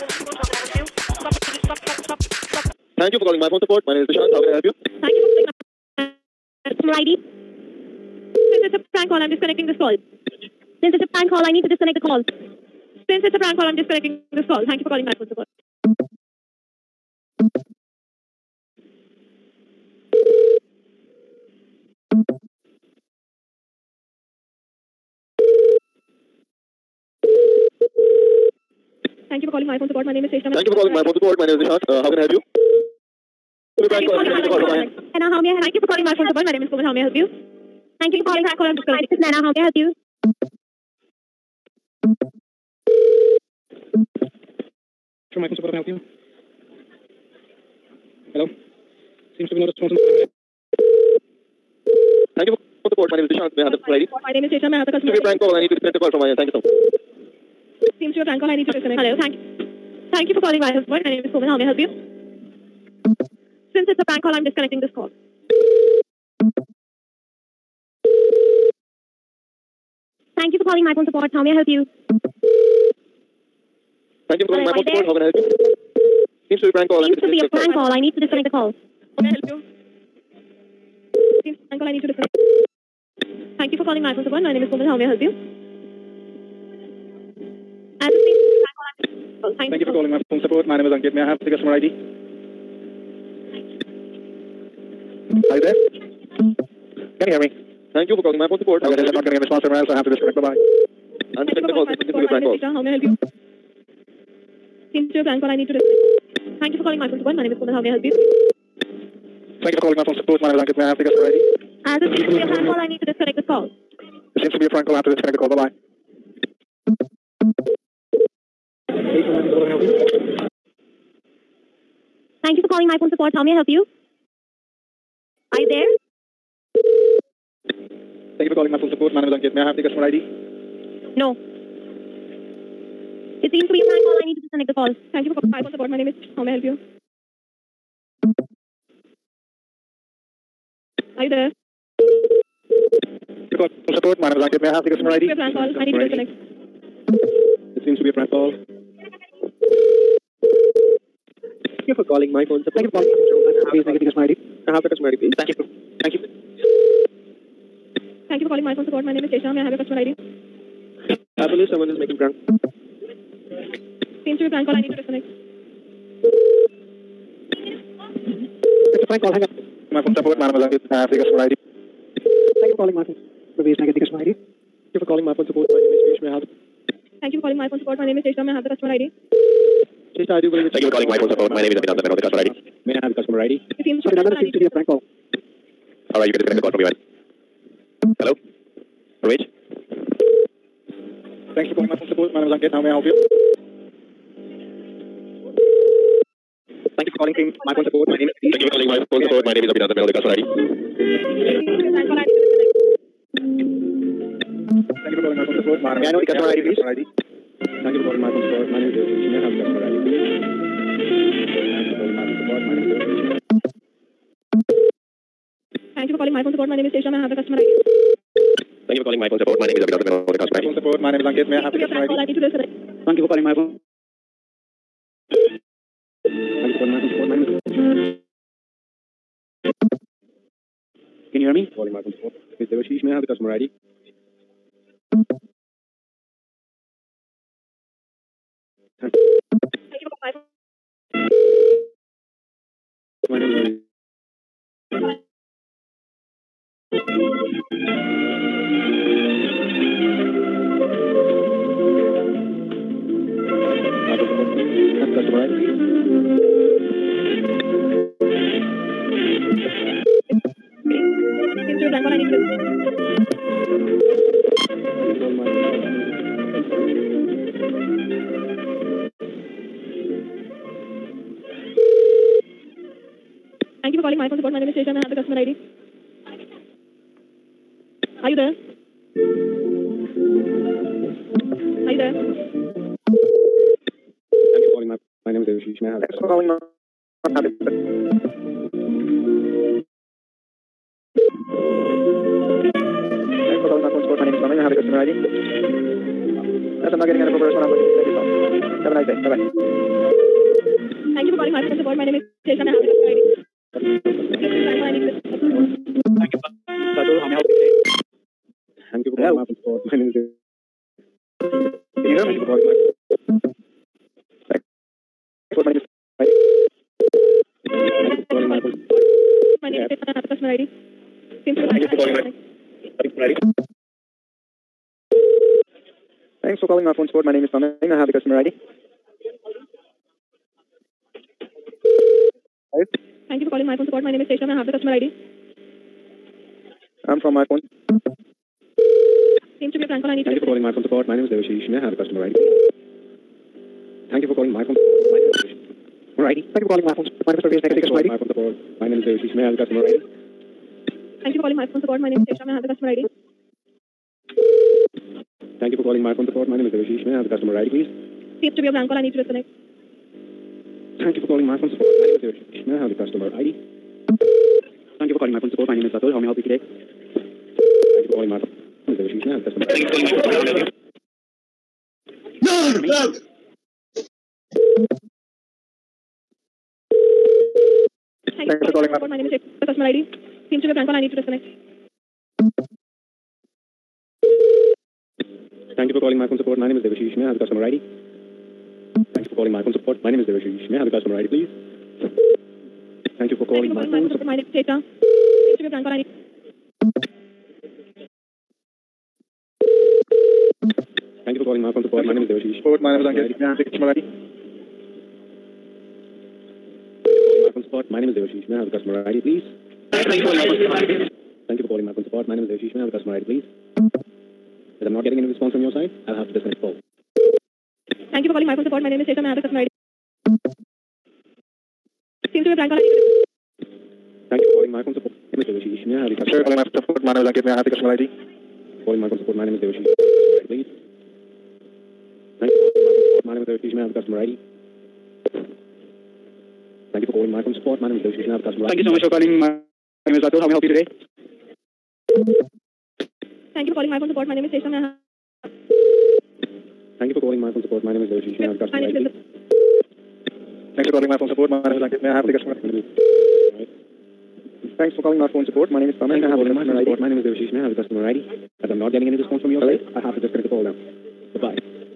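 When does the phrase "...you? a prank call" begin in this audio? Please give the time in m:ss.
1:43.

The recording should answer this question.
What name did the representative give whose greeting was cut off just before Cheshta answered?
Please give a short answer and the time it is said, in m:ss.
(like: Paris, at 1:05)
Piyush, at 2:56.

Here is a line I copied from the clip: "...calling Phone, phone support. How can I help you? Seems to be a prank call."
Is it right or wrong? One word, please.
wrong.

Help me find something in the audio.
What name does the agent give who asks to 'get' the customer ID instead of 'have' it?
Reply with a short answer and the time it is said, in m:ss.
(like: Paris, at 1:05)
Parvez, at 5:47.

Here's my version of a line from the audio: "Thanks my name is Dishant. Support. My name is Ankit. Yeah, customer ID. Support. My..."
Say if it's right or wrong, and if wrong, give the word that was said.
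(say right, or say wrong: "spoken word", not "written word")
wrong: "Devashish", not "Dishant".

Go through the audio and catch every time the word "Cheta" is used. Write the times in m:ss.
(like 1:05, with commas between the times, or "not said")
6:34.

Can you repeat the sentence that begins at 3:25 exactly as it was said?
May I know the customer ID, please?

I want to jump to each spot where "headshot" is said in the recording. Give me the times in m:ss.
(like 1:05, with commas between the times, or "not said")
not said.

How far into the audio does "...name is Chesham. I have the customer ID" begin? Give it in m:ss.
5:02.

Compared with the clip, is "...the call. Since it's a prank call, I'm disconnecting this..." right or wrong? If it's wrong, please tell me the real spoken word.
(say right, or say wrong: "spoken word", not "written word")
right.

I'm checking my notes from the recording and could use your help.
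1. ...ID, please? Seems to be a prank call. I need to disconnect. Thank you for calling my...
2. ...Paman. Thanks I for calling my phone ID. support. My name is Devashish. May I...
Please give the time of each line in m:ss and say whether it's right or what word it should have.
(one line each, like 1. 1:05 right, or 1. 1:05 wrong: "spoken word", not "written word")
1. 5:57 right
2. 7:35 right.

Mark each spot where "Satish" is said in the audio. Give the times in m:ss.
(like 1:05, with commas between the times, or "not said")
3:18.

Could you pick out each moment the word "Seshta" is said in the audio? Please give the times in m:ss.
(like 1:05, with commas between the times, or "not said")
0:30, 5:34.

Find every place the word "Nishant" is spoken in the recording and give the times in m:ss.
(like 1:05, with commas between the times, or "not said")
0:04, 0:31.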